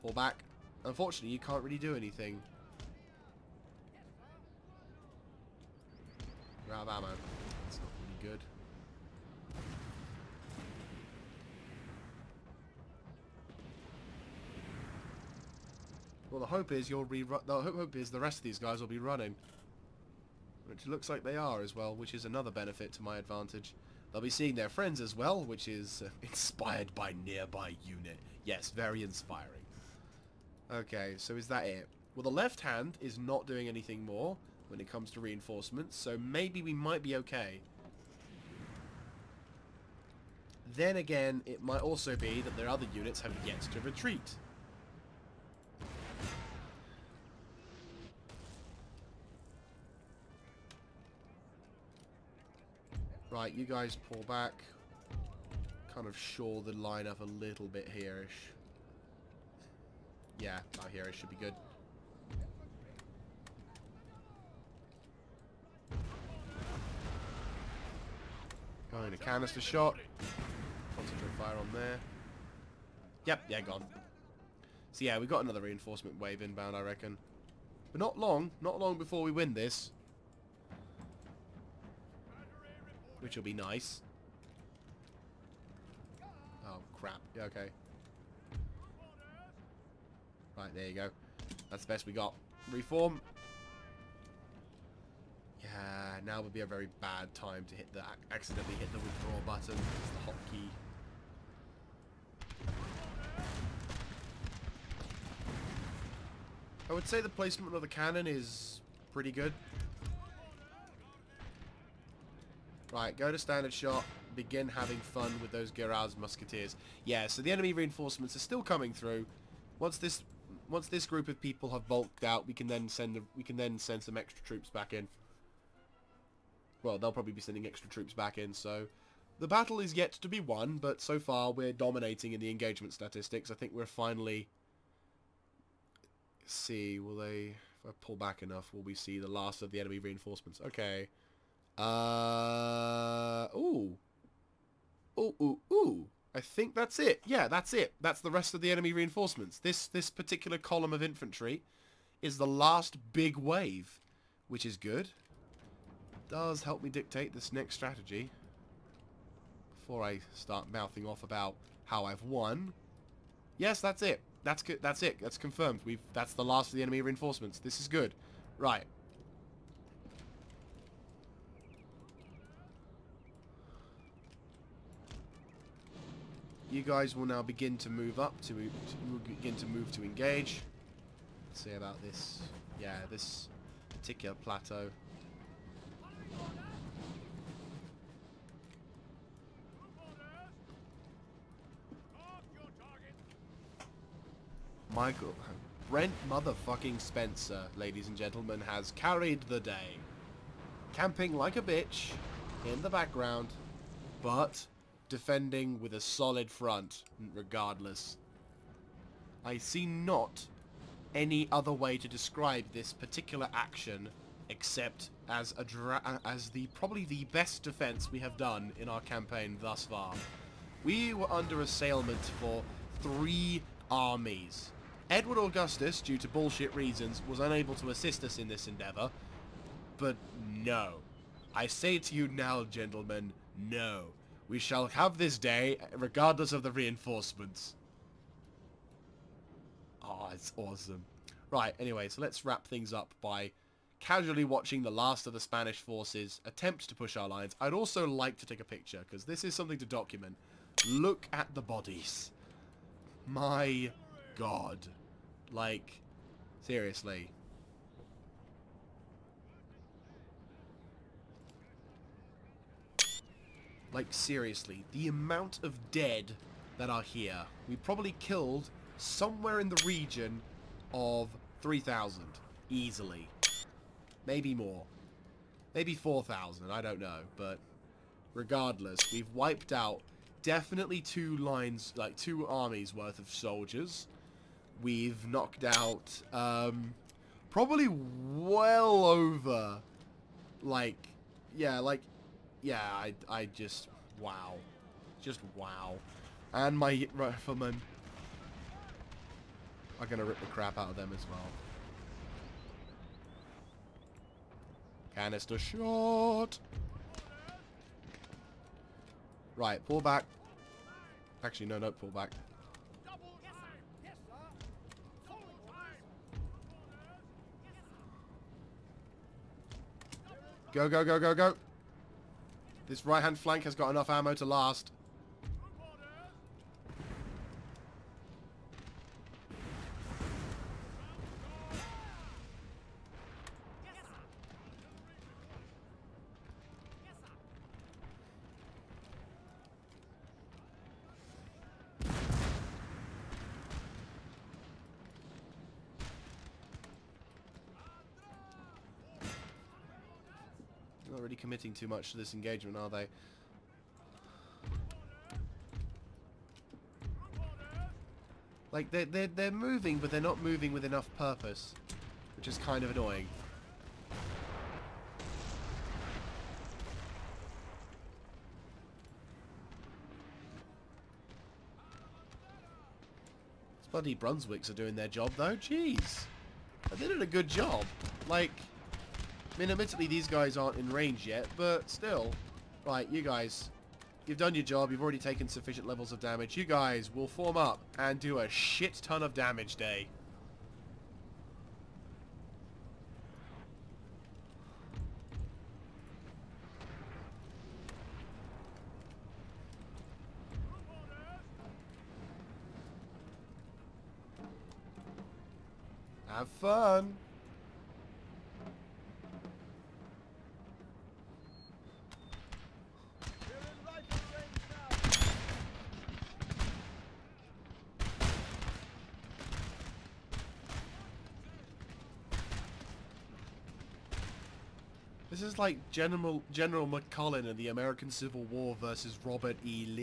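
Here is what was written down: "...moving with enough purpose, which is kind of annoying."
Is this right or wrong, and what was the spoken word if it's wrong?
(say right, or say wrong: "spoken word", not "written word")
right.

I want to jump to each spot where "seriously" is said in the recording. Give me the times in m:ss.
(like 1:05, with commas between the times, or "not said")
4:16, 4:24.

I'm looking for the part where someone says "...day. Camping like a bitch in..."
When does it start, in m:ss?
3:19.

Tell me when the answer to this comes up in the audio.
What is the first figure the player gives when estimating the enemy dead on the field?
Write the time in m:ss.
4:31.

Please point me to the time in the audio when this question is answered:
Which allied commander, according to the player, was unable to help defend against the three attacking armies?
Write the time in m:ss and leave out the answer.
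3:45.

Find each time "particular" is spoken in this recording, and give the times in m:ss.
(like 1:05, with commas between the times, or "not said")
2:30, 3:04, 3:32.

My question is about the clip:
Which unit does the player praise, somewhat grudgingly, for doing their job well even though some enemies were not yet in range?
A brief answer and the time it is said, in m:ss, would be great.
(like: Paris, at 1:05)
Brunswicks, at 6:14.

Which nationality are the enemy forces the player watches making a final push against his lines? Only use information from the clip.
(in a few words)
Spanish.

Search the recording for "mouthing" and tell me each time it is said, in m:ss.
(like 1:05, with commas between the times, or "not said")
2:40.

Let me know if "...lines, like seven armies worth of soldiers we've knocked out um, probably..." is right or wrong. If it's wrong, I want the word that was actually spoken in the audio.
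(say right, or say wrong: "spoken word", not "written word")
wrong: "two", not "seven".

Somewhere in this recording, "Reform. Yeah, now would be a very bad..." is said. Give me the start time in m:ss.
1:32.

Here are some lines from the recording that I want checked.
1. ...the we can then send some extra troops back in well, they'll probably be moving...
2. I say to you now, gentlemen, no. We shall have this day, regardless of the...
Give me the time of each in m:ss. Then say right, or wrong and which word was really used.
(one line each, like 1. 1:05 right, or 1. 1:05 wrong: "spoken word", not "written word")
1. 2:03 wrong: "sending", not "moving"
2. 3:51 right.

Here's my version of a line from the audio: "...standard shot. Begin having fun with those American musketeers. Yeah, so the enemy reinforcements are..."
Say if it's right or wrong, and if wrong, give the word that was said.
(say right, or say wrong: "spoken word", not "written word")
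wrong: "Giraz", not "American".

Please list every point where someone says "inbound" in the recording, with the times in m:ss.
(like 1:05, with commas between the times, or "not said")
1:16.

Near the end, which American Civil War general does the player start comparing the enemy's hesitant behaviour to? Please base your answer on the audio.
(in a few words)
General McClellan.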